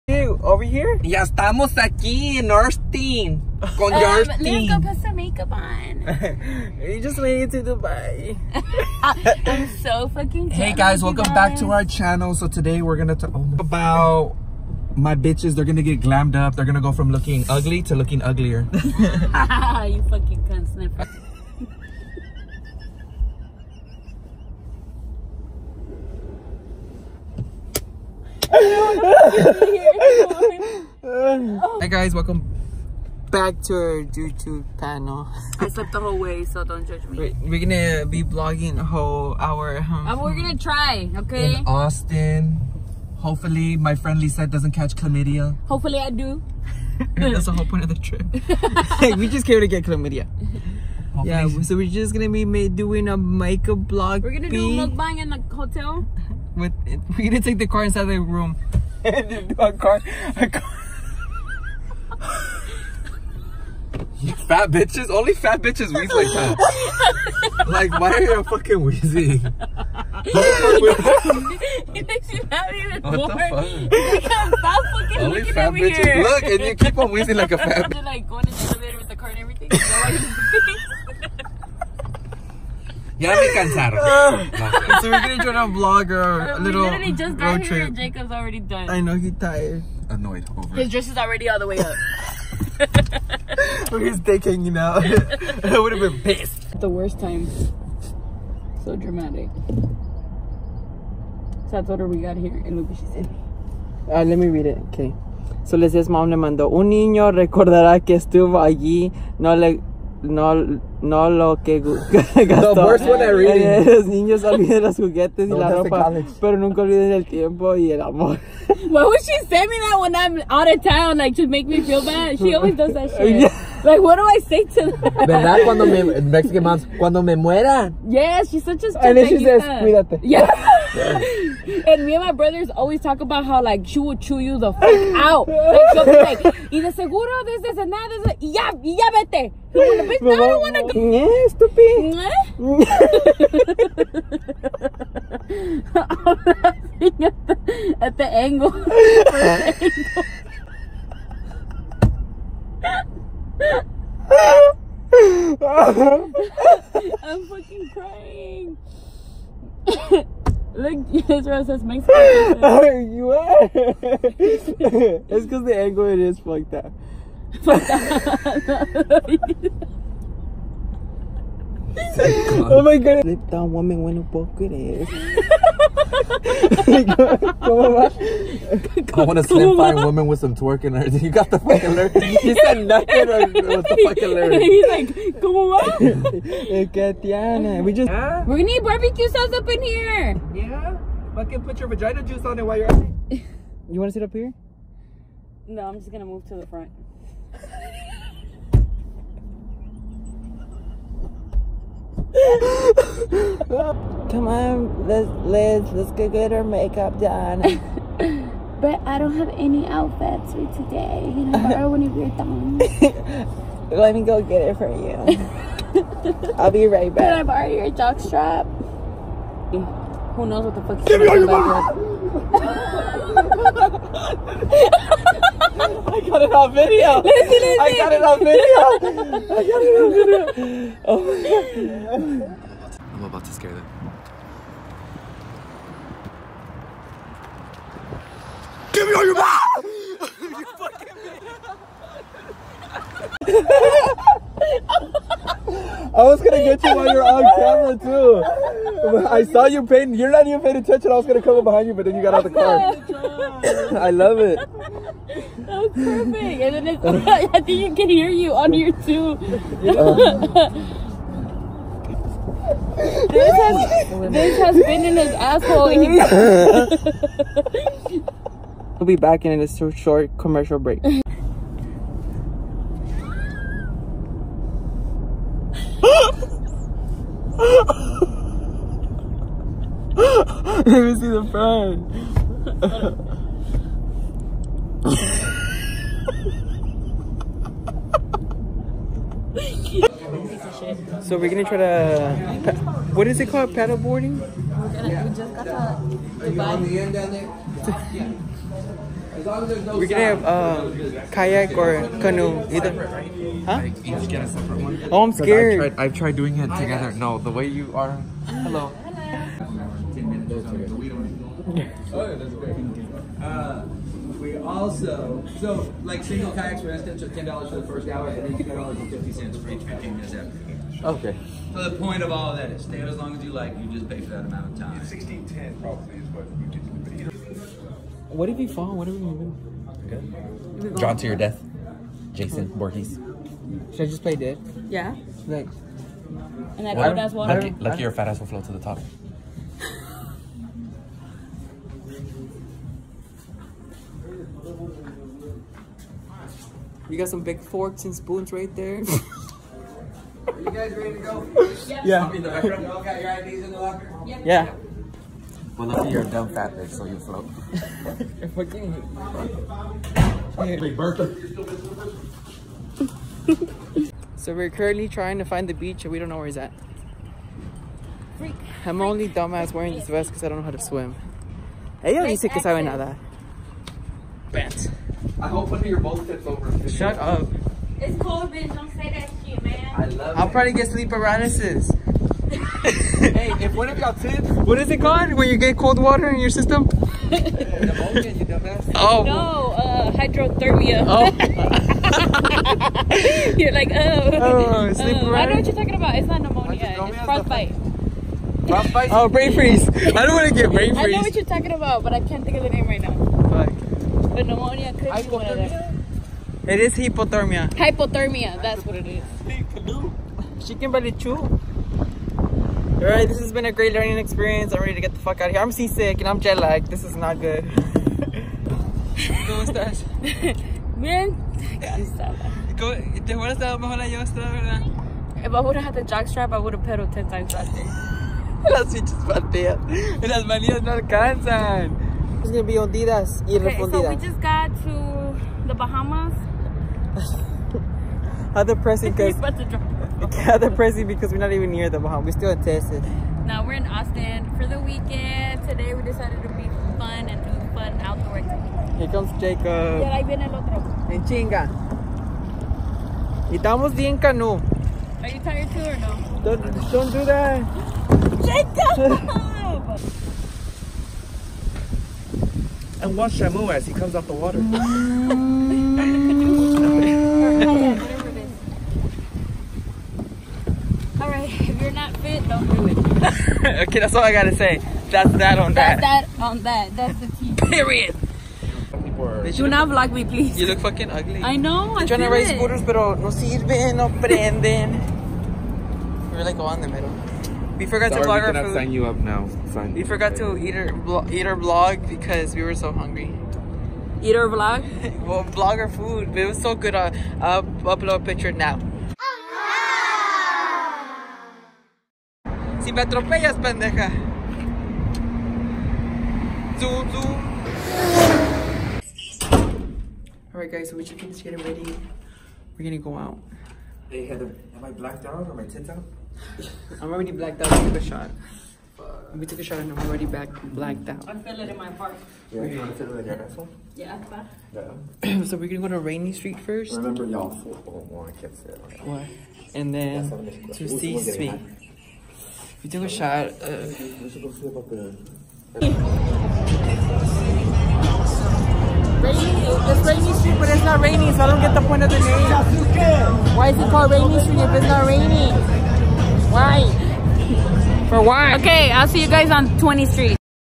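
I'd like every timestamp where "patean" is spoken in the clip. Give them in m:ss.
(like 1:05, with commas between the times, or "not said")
7:09.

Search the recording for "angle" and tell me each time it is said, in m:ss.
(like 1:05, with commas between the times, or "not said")
2:28, 2:37, 2:45.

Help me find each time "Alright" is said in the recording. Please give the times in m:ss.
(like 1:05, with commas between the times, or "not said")
6:53, 8:30.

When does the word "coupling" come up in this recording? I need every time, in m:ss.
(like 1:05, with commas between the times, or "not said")
not said.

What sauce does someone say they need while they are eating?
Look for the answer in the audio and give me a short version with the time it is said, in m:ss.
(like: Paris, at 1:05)
Barbecue sauce, at 3:08.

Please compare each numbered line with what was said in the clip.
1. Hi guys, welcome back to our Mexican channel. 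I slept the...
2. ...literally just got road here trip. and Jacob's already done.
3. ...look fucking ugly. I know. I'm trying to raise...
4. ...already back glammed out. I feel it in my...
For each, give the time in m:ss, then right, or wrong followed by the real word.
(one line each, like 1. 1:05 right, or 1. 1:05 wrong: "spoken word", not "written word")
1. 0:28 wrong: "YouTube", not "Mexican"
2. 1:26 right
3. 8:00 right
4. 8:40 wrong: "blacked", not "glammed".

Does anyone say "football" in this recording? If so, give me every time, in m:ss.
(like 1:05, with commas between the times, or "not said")
8:47.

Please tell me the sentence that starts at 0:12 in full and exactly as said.
So today we're gonna talk about my bitches.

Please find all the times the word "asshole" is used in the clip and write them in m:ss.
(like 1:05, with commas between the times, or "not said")
4:25, 8:43.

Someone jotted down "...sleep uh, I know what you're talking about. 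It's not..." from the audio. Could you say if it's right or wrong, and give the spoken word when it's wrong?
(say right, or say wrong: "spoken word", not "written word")
right.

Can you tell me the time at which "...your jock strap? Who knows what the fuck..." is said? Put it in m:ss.
3:37.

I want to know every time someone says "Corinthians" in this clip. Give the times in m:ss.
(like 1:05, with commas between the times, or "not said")
not said.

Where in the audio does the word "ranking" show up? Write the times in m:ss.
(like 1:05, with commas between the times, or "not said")
not said.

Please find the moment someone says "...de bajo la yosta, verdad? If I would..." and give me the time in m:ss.
7:03.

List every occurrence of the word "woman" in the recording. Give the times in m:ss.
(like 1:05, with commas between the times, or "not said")
2:53, 2:59.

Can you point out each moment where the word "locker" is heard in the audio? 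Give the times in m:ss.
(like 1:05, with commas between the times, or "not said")
5:53.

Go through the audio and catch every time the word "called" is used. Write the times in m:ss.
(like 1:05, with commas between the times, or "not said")
4:53, 6:25, 9:03.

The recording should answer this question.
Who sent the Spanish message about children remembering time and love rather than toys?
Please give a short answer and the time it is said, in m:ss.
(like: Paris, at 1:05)
Mom, at 1:46.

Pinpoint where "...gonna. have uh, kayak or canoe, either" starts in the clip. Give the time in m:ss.
5:00.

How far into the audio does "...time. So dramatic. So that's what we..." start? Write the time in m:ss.
1:37.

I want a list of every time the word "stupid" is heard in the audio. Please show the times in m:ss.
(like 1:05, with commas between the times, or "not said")
2:08, 2:21.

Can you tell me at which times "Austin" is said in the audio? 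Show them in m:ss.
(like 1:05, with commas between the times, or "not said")
0:41, 7:23.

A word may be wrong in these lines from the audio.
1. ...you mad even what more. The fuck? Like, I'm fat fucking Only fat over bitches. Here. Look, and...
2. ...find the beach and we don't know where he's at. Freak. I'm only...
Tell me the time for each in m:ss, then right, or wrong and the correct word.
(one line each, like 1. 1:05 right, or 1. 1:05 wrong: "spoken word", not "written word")
1. 1:12 right
2. 6:05 right.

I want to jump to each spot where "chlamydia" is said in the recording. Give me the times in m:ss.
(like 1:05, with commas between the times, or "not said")
0:44, 0:49.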